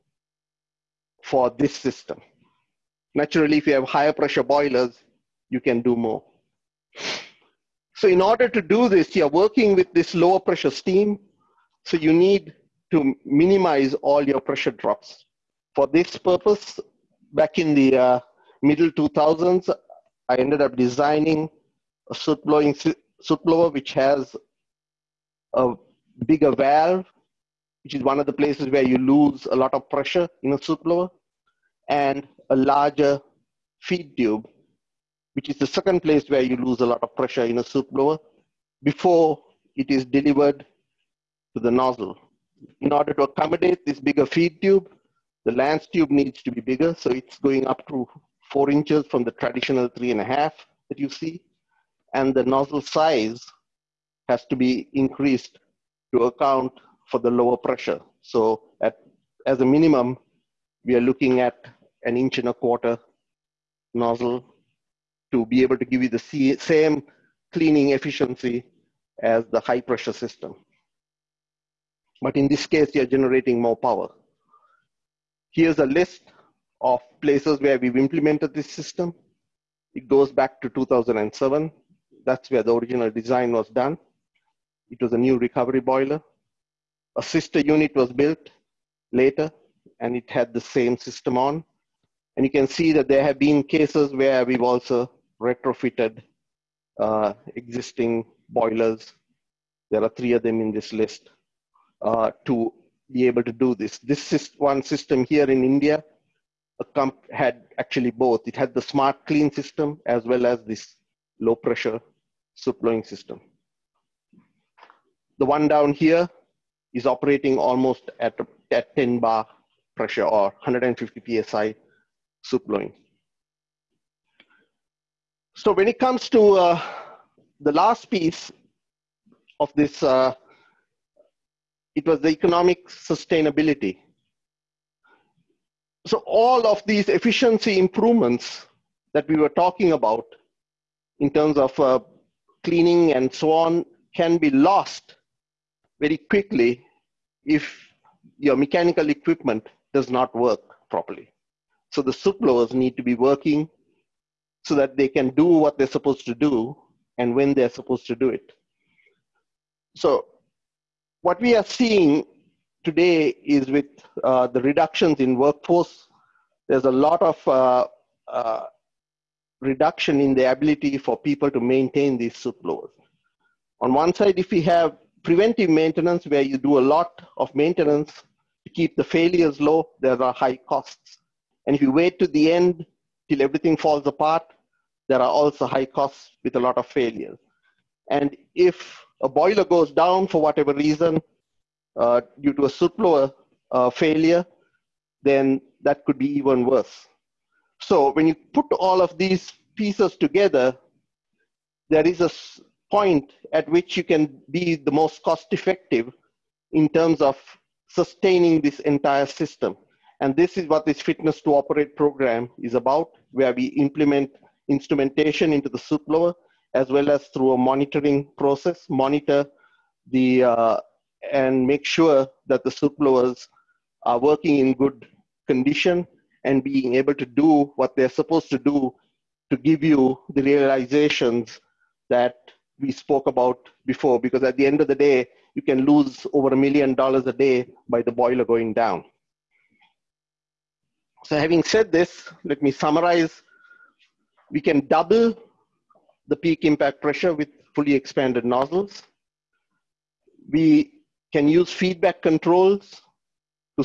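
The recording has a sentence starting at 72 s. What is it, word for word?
But in this case, you're generating more power.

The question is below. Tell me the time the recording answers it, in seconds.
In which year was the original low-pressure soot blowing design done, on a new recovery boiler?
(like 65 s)
80 s.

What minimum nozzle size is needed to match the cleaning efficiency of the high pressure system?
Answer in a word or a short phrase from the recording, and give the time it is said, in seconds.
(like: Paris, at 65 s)
1 1/4 inch, at 62 s.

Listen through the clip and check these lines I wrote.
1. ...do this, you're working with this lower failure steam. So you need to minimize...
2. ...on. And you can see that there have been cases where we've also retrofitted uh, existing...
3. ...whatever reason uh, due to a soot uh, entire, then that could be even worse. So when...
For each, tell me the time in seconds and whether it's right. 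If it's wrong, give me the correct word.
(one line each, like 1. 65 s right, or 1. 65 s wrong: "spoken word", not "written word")
1. 8 s wrong: "pressure", not "failure"
2. 91 s right
3. 190 s wrong: "failure", not "entire".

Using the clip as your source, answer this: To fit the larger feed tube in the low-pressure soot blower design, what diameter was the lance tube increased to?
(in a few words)
4 inches.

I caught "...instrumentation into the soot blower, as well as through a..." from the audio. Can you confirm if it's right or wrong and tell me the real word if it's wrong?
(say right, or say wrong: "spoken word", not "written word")
right.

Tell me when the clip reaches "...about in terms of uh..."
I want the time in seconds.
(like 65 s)
139 s.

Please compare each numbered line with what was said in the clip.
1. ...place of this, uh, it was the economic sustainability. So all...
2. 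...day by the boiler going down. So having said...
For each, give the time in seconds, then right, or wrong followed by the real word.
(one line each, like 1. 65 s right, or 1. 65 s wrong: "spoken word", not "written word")
1. 128 s wrong: "piece", not "place"
2. 237 s right.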